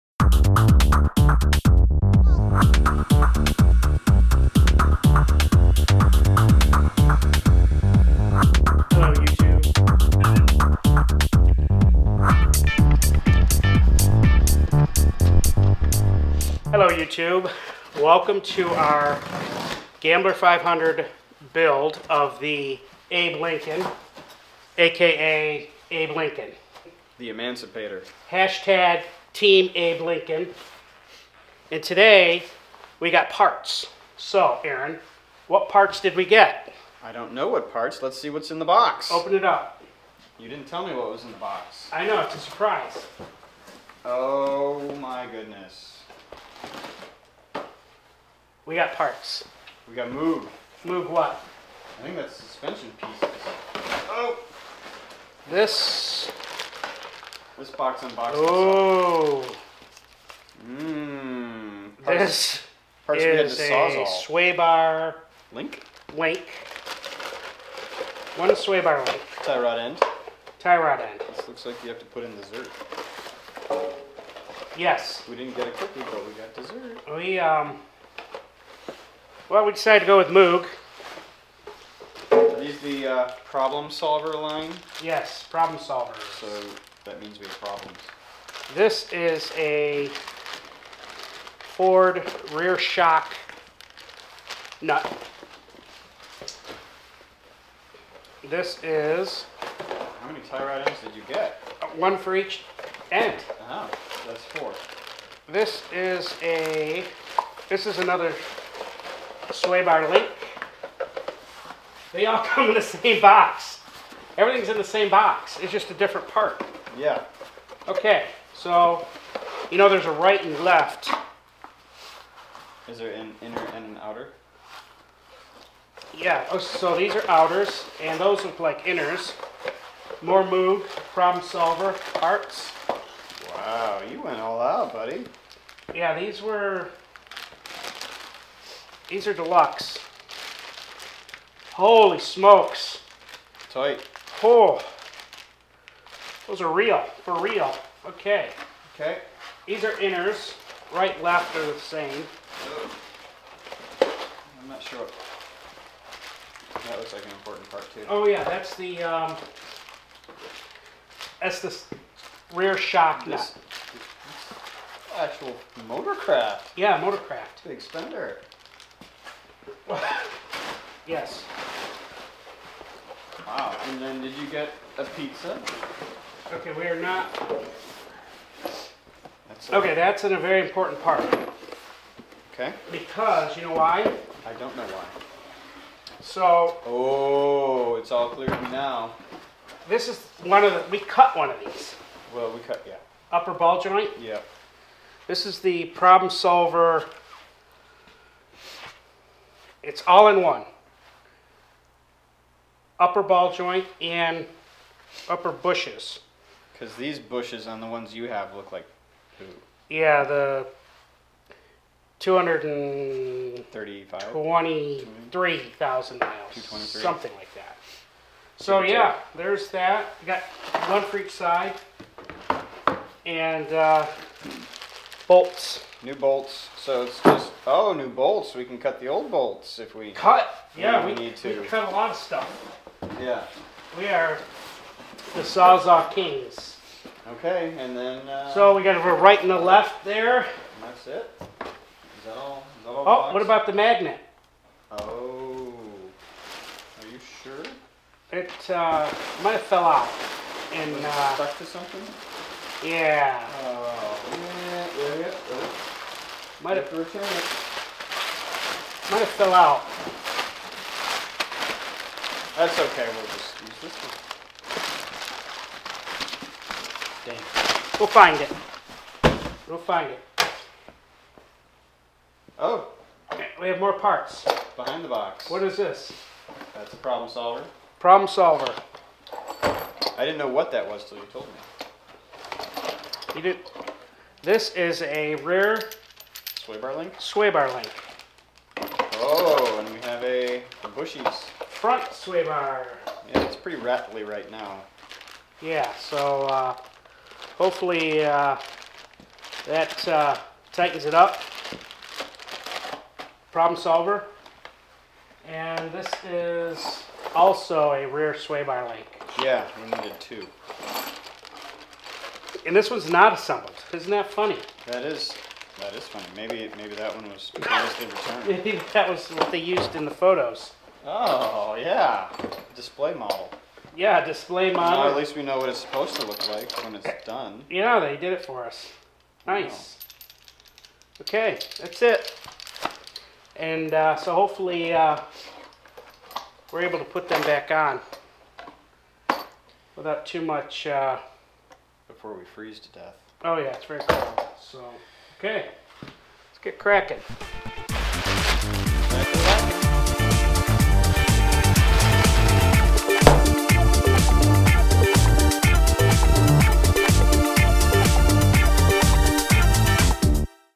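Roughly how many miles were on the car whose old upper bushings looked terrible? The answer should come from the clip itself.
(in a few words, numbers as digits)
223,000.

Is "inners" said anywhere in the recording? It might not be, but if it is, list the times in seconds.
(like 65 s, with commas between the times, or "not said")
123 s, 128 s, 149 s.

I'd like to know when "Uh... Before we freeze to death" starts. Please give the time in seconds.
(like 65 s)
340 s.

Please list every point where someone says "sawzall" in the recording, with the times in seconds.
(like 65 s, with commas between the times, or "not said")
235 s.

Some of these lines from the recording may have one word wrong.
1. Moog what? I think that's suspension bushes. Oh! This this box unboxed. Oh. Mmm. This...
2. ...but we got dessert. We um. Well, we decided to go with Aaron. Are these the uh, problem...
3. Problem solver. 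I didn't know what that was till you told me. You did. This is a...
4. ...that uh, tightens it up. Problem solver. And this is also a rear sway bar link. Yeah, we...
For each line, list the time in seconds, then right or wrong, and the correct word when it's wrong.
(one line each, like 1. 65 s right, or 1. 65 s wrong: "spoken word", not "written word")
1. 50 s wrong: "pieces", not "bushes"
2. 75 s wrong: "Moog", not "Aaron"
3. 277 s right
4. 299 s right.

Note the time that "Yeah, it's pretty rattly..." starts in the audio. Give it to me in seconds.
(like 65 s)
293 s.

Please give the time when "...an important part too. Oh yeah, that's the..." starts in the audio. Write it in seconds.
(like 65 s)
157 s.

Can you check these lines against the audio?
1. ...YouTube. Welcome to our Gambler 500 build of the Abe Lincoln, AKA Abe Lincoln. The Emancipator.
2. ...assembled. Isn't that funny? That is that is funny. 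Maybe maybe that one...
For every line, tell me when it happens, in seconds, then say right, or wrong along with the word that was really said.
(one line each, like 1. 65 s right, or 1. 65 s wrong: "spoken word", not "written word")
1. 16 s right
2. 313 s right.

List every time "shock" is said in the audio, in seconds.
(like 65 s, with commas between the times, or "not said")
92 s, 162 s.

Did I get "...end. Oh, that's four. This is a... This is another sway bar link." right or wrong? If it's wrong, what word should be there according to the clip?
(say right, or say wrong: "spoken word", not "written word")
right.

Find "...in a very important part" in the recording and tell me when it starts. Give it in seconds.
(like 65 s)
180 s.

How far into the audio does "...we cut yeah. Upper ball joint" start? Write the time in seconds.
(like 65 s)
192 s.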